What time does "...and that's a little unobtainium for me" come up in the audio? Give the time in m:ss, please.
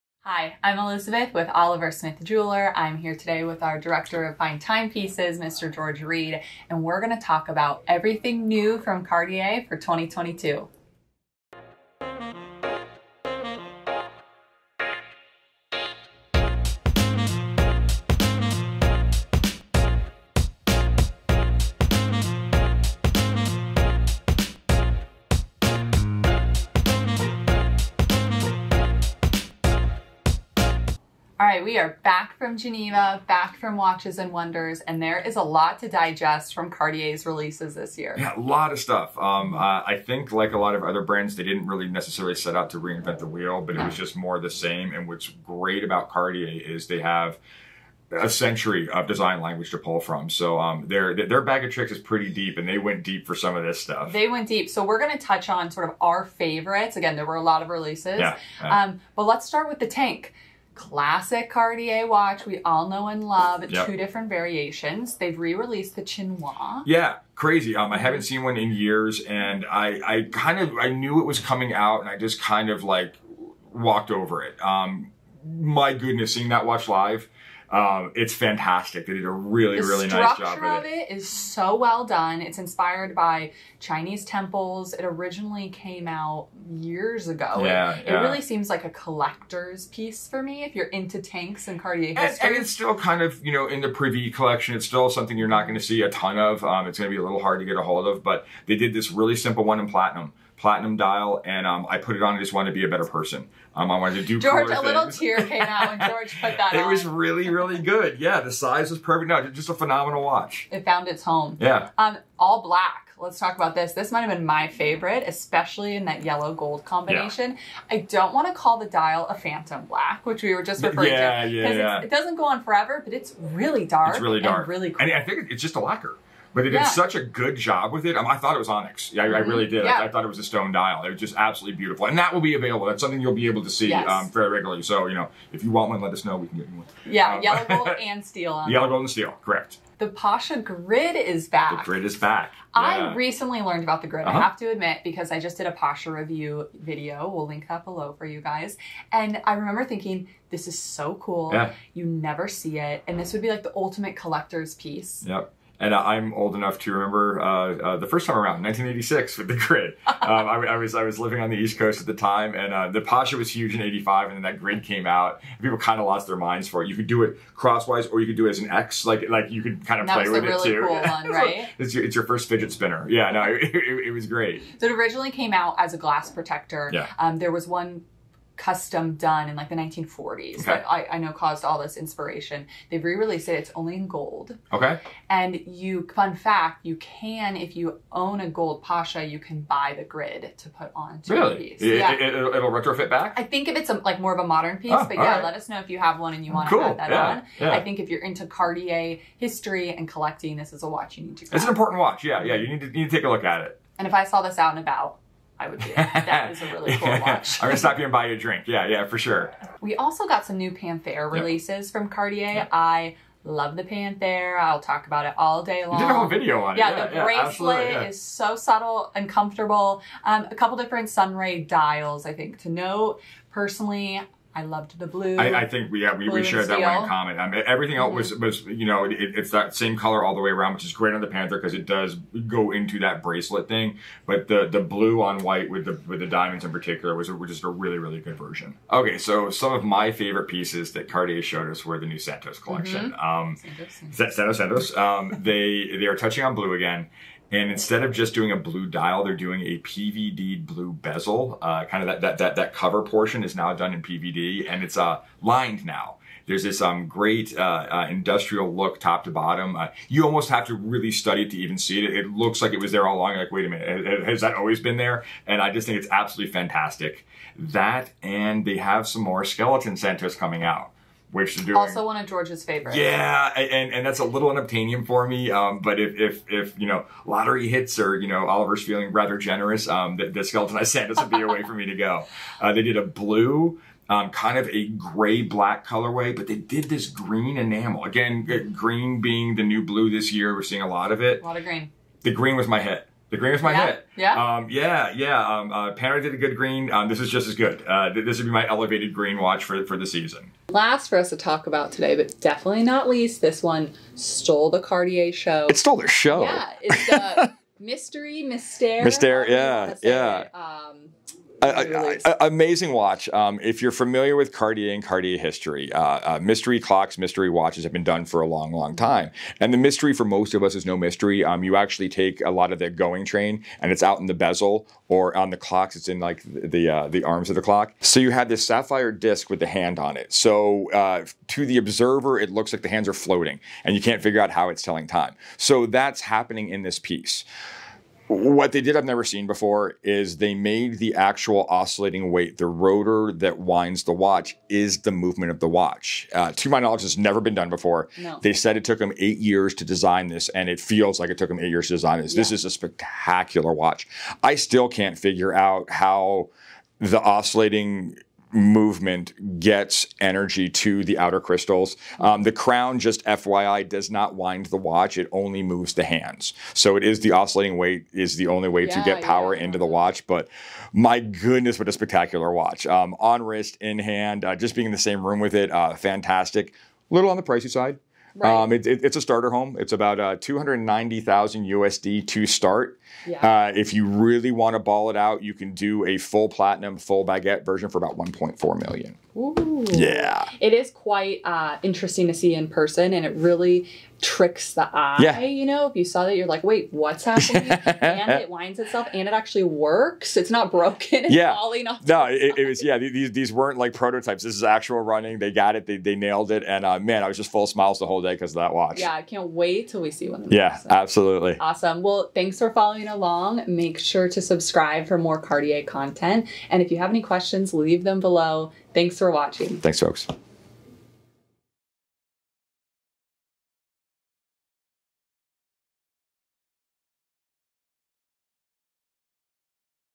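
4:33.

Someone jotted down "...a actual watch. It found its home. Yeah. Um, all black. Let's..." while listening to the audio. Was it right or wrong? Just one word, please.
wrong.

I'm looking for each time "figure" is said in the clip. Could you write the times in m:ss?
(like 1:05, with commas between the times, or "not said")
5:34, 5:55.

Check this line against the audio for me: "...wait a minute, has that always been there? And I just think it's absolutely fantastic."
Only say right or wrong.
right.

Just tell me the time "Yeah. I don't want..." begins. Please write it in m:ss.
1:57.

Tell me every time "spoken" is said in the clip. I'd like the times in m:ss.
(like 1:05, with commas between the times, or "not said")
not said.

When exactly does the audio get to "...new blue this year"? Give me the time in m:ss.
4:49.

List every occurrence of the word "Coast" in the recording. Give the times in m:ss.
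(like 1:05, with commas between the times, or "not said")
2:41.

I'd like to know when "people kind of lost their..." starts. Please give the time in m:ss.
2:45.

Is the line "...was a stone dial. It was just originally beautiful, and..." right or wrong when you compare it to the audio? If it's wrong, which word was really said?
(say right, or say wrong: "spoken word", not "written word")
wrong: "absolutely", not "originally".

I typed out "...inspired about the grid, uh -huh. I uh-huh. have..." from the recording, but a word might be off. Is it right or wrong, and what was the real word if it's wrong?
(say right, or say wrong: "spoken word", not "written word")
wrong: "learned", not "inspired".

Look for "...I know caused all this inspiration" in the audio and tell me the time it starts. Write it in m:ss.
3:01.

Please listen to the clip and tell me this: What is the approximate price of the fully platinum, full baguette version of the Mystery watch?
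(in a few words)
1.4 million.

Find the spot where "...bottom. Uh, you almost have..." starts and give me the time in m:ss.
4:19.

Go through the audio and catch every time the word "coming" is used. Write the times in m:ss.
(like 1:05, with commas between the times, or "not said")
1:11, 4:30.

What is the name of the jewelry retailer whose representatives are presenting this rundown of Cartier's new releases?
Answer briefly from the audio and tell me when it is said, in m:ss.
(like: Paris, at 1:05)
Oliver Smith Jeweler, at 0:01.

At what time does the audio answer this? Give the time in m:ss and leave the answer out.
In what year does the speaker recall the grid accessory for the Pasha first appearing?
2:38.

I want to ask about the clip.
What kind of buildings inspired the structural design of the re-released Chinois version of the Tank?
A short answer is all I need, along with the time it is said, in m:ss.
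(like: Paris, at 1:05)
Chinese temples, at 1:23.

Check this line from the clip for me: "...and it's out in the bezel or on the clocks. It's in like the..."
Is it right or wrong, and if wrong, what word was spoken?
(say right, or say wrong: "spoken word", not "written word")
right.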